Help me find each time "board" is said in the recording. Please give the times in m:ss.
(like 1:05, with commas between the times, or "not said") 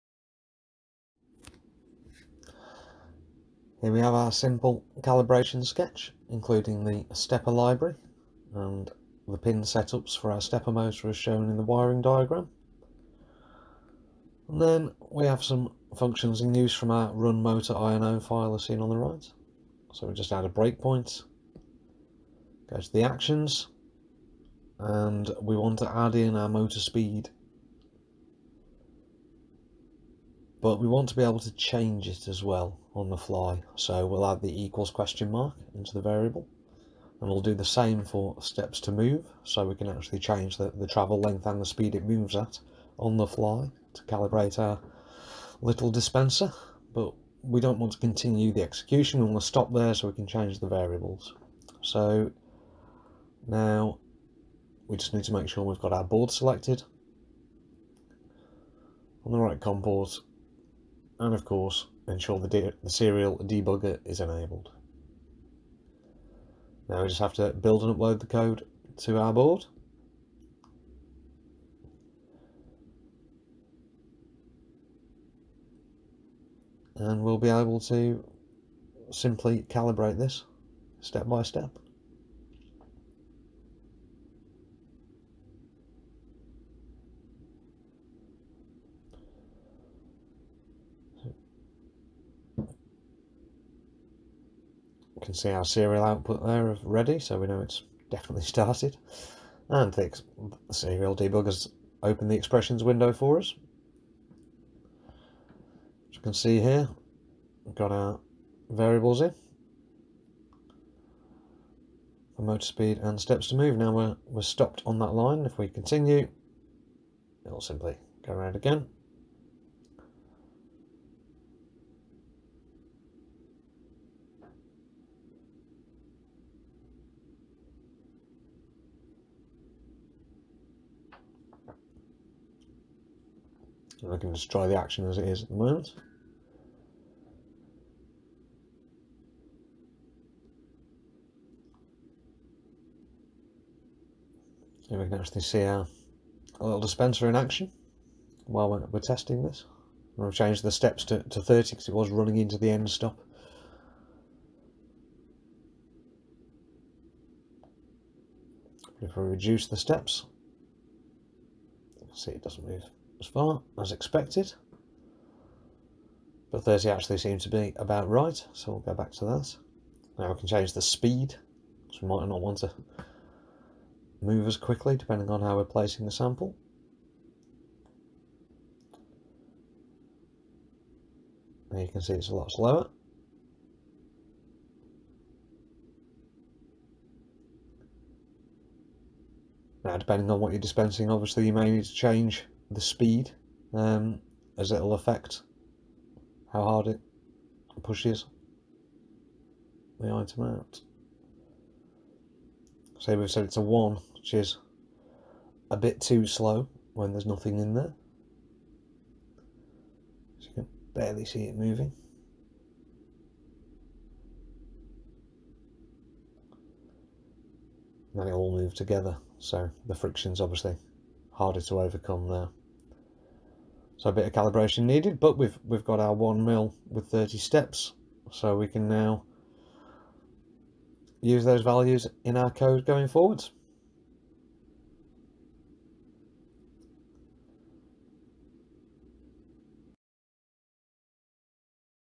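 0:56, 1:09.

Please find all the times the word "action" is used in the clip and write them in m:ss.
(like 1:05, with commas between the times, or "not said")
0:23, 2:14, 2:27.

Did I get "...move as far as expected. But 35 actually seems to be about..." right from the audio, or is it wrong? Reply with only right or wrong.
wrong.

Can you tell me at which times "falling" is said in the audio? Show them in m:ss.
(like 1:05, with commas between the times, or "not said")
not said.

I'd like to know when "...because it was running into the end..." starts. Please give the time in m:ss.
2:31.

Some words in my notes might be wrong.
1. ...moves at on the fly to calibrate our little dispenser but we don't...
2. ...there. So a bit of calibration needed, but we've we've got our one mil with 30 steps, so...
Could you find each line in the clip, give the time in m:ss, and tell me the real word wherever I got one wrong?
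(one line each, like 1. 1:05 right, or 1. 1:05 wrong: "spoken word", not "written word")
1. 0:42 right
2. 3:42 right.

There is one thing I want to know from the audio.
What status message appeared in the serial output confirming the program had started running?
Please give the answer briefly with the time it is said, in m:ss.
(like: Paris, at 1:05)
Ready, at 1:36.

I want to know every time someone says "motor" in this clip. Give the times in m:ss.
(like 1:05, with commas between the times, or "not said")
0:10, 0:17, 0:26, 1:52.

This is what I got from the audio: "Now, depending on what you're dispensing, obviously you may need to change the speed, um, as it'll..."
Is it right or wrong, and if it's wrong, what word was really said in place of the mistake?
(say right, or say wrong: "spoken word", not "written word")
right.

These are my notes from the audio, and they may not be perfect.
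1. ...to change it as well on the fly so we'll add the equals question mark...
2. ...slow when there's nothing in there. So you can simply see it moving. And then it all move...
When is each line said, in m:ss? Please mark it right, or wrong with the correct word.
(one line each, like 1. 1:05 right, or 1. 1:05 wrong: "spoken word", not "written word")
1. 0:31 right
2. 3:26 wrong: "barely", not "simply".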